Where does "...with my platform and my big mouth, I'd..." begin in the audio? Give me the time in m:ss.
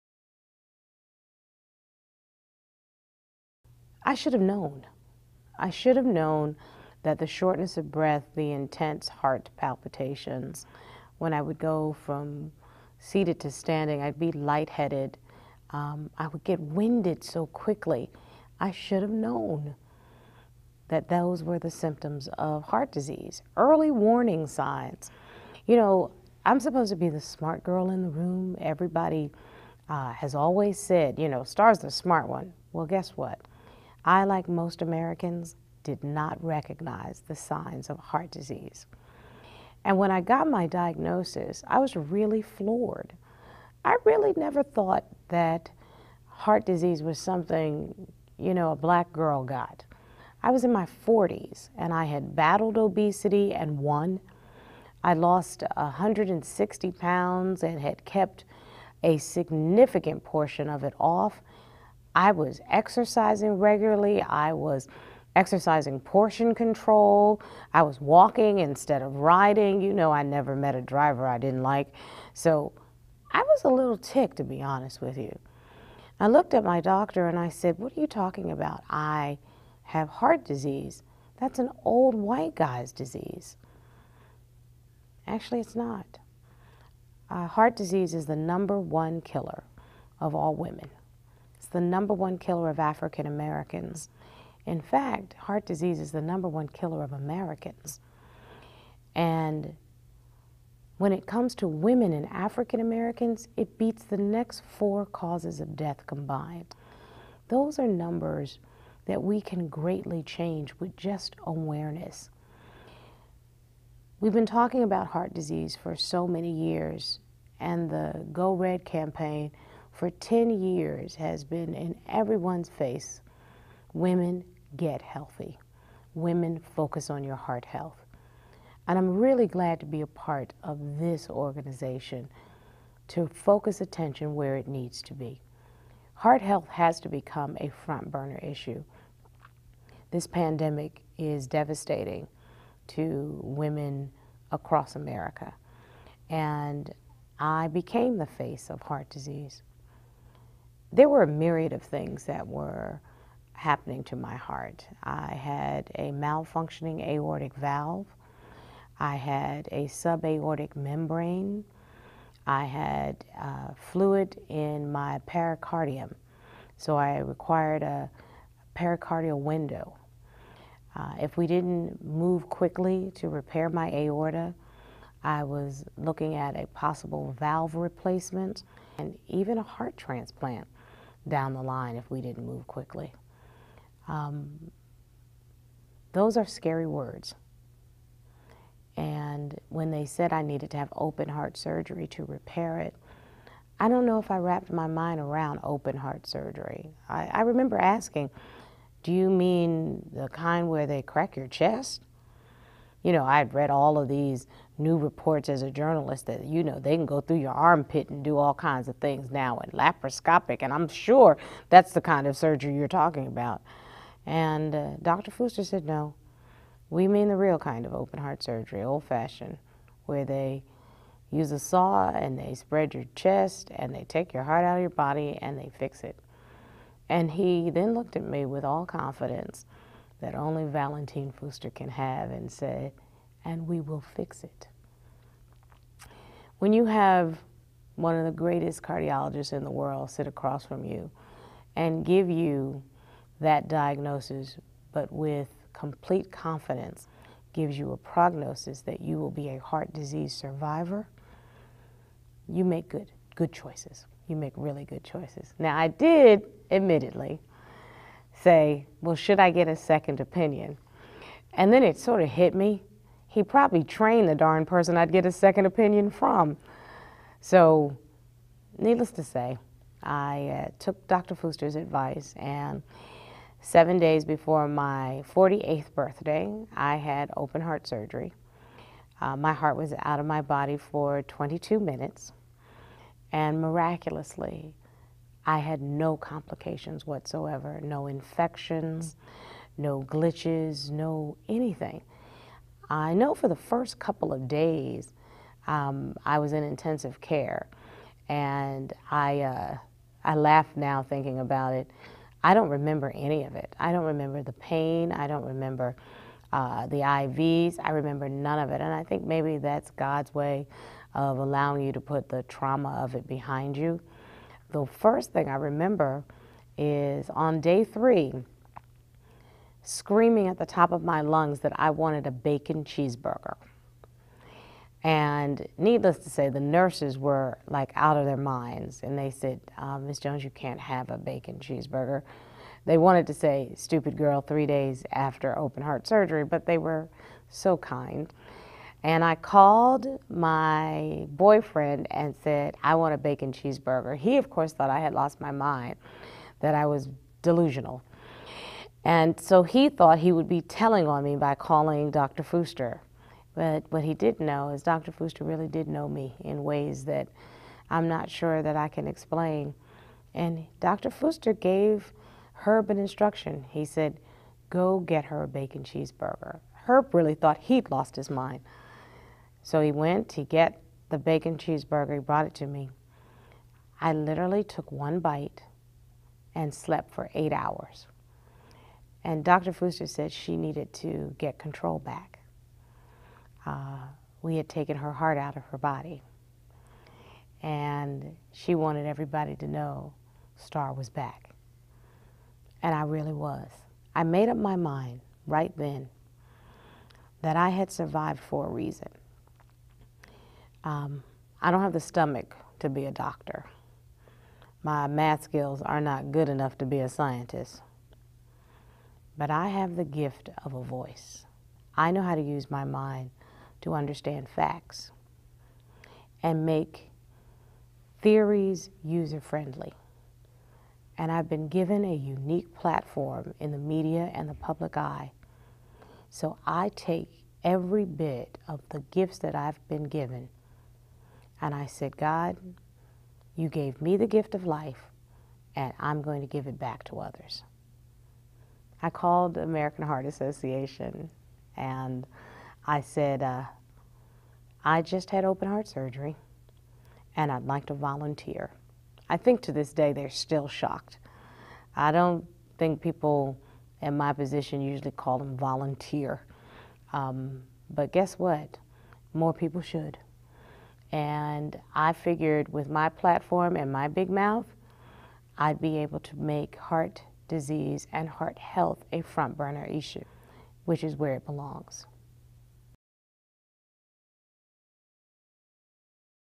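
7:42.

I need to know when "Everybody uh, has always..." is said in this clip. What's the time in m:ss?
0:28.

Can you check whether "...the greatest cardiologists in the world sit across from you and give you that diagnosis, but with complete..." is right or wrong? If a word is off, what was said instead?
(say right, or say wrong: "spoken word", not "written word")
right.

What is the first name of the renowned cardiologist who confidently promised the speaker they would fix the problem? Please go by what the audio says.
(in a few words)
Valentine.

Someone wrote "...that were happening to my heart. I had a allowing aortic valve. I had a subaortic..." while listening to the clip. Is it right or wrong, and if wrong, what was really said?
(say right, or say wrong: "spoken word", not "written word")
wrong: "malfunctioning", not "allowing".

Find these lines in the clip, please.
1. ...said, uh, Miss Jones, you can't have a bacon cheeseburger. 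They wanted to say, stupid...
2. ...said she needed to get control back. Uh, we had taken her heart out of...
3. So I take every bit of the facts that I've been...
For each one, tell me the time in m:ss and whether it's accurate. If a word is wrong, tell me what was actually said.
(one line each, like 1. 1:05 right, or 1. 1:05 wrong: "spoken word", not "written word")
1. 5:29 right
2. 6:20 right
3. 7:06 wrong: "gifts", not "facts".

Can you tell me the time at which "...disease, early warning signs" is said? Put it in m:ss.
0:22.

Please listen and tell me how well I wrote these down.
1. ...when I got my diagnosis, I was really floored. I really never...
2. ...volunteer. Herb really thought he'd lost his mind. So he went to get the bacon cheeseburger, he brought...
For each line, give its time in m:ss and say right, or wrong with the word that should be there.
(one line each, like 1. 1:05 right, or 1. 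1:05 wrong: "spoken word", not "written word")
1. 0:39 right
2. 6:05 wrong: "cheeseburger", not "volunteer".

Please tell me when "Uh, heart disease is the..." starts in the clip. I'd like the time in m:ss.
1:27.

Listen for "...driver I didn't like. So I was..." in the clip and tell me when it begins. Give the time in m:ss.
1:10.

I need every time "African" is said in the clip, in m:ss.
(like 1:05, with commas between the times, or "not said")
1:32, 1:42.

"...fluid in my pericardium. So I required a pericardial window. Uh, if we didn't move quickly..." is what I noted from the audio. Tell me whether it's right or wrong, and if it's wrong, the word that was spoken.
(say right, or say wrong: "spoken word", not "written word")
right.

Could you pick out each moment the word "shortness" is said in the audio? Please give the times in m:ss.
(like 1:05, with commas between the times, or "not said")
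0:07.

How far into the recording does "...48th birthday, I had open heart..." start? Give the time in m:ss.
4:35.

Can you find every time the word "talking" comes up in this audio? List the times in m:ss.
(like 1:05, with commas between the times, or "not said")
1:18, 1:54, 3:32.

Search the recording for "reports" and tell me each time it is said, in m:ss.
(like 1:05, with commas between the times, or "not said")
3:24.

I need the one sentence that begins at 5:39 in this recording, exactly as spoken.
And I called my boyfriend and said, I want a bacon cheeseburger.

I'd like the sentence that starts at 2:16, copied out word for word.
Heart health has to become a front burner issue.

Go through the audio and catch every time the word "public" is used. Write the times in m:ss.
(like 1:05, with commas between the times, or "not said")
7:04.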